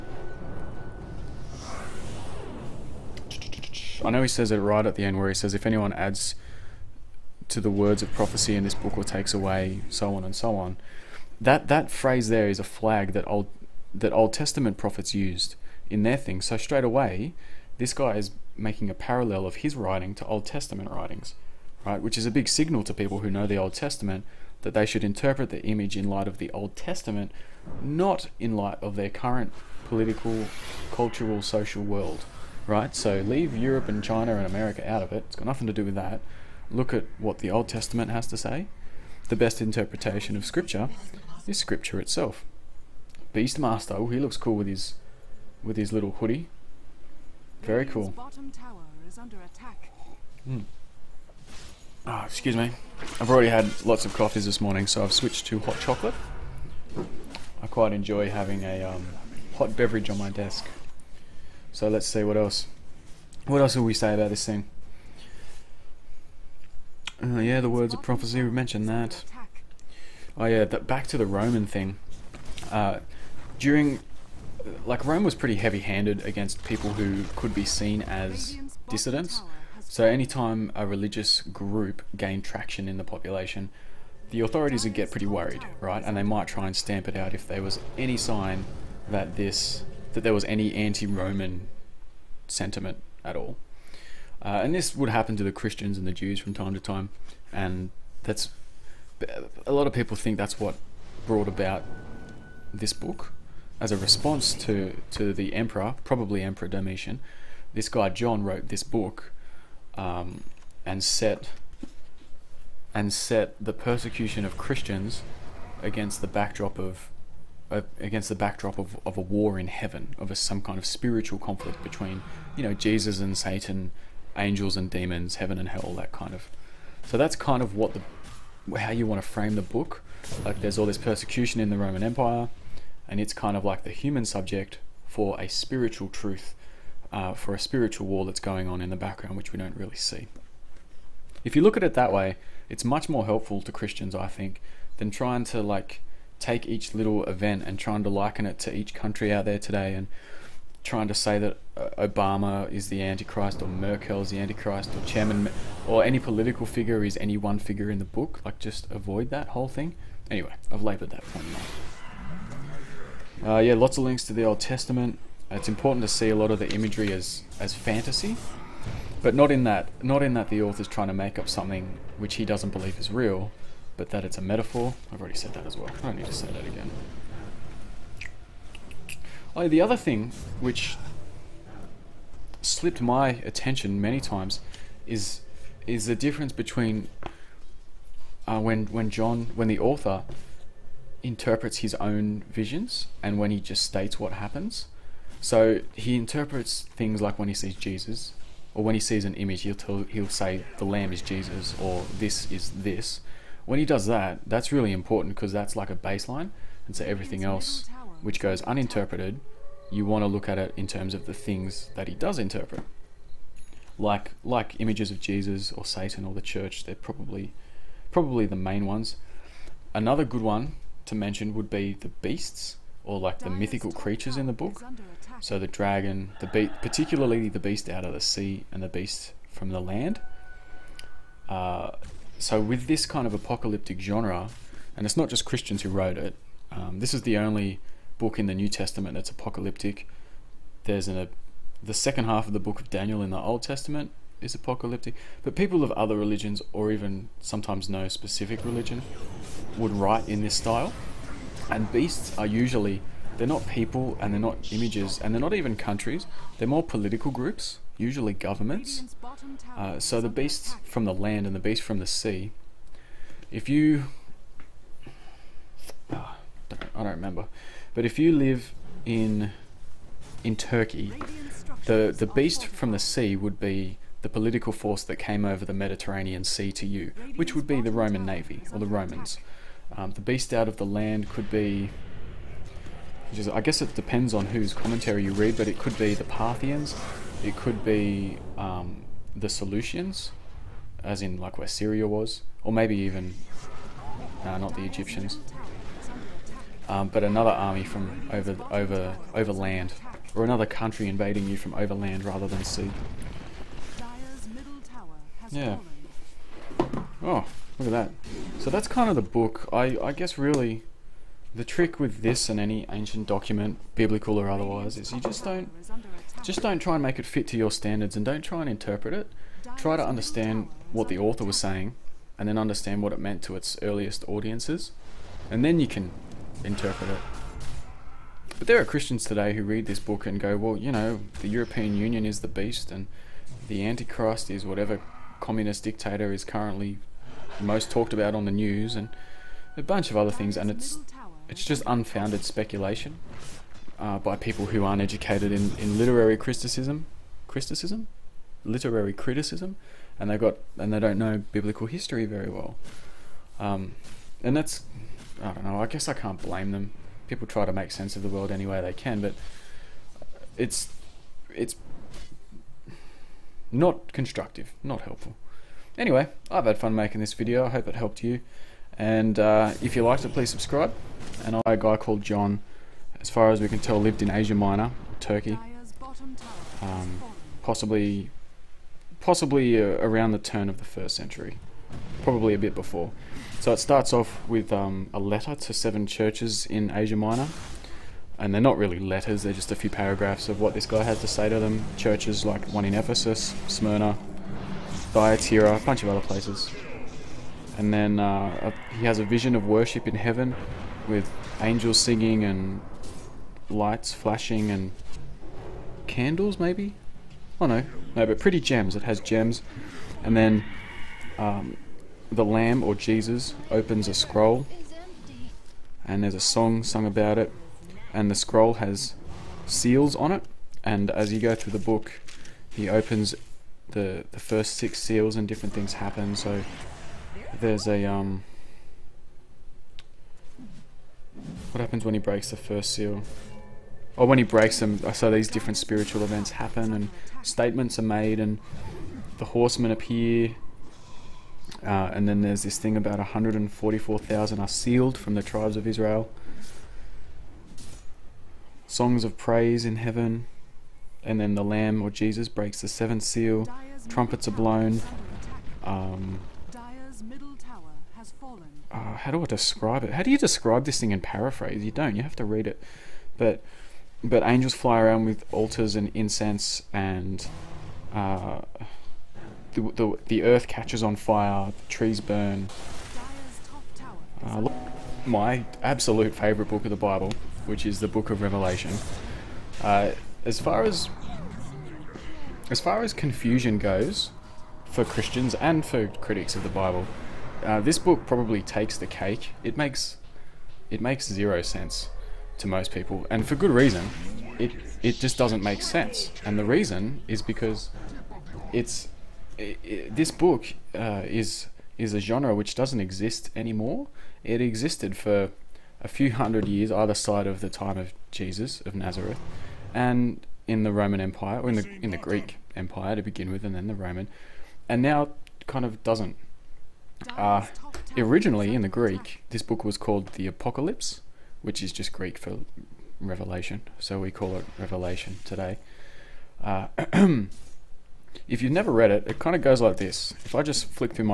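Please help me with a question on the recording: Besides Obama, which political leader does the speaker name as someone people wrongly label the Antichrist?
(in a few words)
Merkel.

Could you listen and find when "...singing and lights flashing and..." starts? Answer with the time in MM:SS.
06:41.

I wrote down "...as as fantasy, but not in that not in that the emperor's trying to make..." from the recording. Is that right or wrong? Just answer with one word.
wrong.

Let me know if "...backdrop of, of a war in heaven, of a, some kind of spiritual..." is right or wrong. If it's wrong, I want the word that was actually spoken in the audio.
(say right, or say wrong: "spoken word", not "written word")
right.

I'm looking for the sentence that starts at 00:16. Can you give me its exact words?
So straight away, this guy is making a parallel of his writing to Old Testament writings, right?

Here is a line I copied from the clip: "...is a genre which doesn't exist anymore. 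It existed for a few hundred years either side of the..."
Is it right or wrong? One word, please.
right.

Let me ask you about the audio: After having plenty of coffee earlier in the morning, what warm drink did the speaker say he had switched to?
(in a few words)
hot chocolate.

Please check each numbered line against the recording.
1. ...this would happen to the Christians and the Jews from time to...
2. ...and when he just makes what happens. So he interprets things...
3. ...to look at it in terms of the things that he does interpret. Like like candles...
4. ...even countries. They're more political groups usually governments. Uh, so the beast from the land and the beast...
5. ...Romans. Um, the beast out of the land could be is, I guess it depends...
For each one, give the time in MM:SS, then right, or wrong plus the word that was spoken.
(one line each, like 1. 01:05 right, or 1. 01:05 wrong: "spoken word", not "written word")
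1. 01:34 right
2. 03:13 wrong: "states", not "makes"
3. 03:30 wrong: "images", not "candles"
4. 04:15 right
5. 04:38 right.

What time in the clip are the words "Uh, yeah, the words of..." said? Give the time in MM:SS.
01:07.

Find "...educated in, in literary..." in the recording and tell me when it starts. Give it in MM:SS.
05:45.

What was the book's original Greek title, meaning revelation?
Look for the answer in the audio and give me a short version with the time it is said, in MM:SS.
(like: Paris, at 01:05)
Apocalypse, at 08:40.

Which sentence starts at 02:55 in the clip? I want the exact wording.
I've already said that as well.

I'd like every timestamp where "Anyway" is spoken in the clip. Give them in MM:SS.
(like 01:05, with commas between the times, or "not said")
02:40, 06:05.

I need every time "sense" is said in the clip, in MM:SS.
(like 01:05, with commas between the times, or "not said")
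05:57, 08:11, 08:15.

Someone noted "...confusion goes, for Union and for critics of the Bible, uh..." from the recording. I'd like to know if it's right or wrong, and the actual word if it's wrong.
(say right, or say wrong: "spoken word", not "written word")
wrong: "Christians", not "Union".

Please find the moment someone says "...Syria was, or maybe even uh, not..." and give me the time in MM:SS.
04:51.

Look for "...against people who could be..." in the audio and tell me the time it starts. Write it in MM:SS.
01:16.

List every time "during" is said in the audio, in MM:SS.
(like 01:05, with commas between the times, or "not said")
01:13.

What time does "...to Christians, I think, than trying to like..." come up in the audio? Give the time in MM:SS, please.
02:23.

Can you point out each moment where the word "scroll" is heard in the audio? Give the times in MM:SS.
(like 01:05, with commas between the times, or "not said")
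06:54, 06:58.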